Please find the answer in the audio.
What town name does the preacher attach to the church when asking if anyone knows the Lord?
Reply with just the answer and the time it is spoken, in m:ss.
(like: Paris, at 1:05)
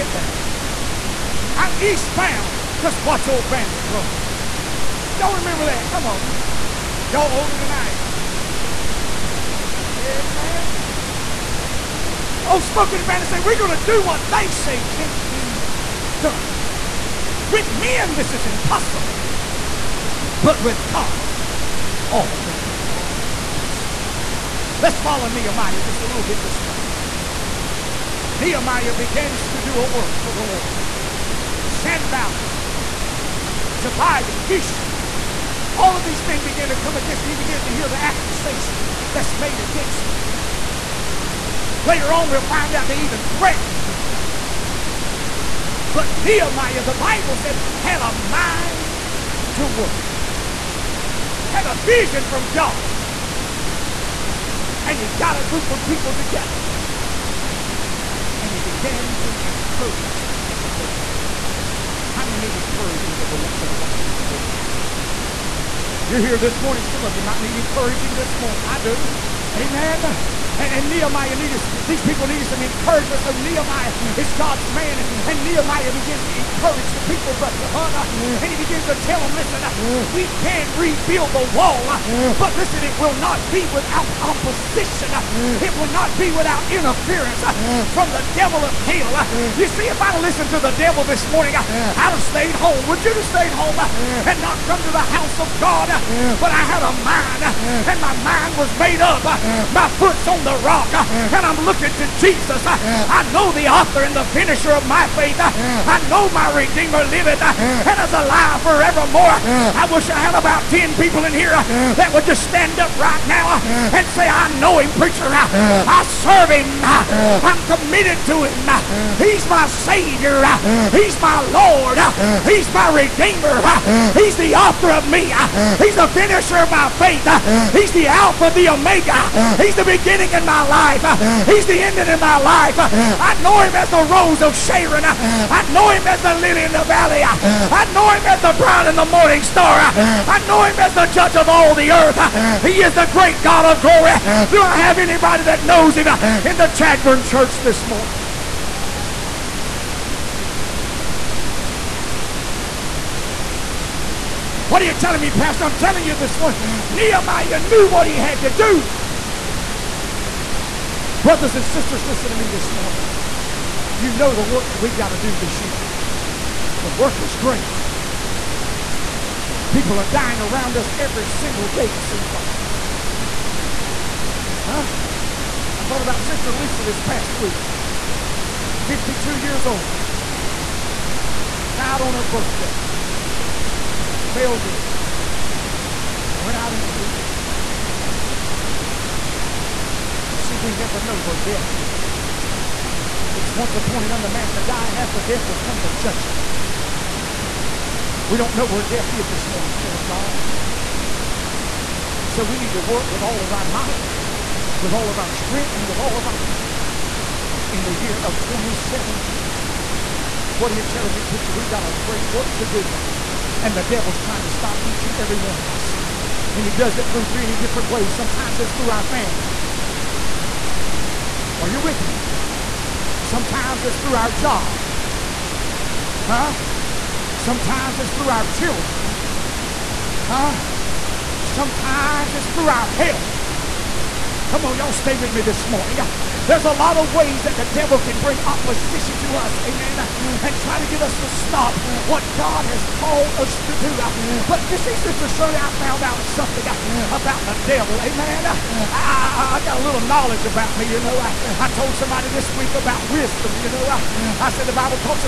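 Chadbourn, at 2:26.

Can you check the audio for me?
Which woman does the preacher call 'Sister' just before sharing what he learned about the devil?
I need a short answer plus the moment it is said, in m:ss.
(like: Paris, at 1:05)
Shirley, at 4:04.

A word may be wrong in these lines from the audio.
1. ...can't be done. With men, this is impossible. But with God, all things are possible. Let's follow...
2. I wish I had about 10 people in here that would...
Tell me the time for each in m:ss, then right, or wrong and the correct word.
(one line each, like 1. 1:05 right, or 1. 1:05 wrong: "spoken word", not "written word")
1. 0:14 right
2. 1:49 right.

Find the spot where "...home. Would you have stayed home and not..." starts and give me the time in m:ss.
1:32.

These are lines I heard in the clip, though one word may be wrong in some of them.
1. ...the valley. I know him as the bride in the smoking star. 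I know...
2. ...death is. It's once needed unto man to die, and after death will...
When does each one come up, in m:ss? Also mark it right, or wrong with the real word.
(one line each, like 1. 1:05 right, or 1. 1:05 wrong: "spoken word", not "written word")
1. 2:16 wrong: "morning", not "smoking"
2. 3:11 wrong: "appointed", not "needed".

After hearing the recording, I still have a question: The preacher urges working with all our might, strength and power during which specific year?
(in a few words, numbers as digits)
2017.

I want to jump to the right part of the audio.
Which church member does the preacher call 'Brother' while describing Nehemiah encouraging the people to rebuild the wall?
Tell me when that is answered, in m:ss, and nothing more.
1:17.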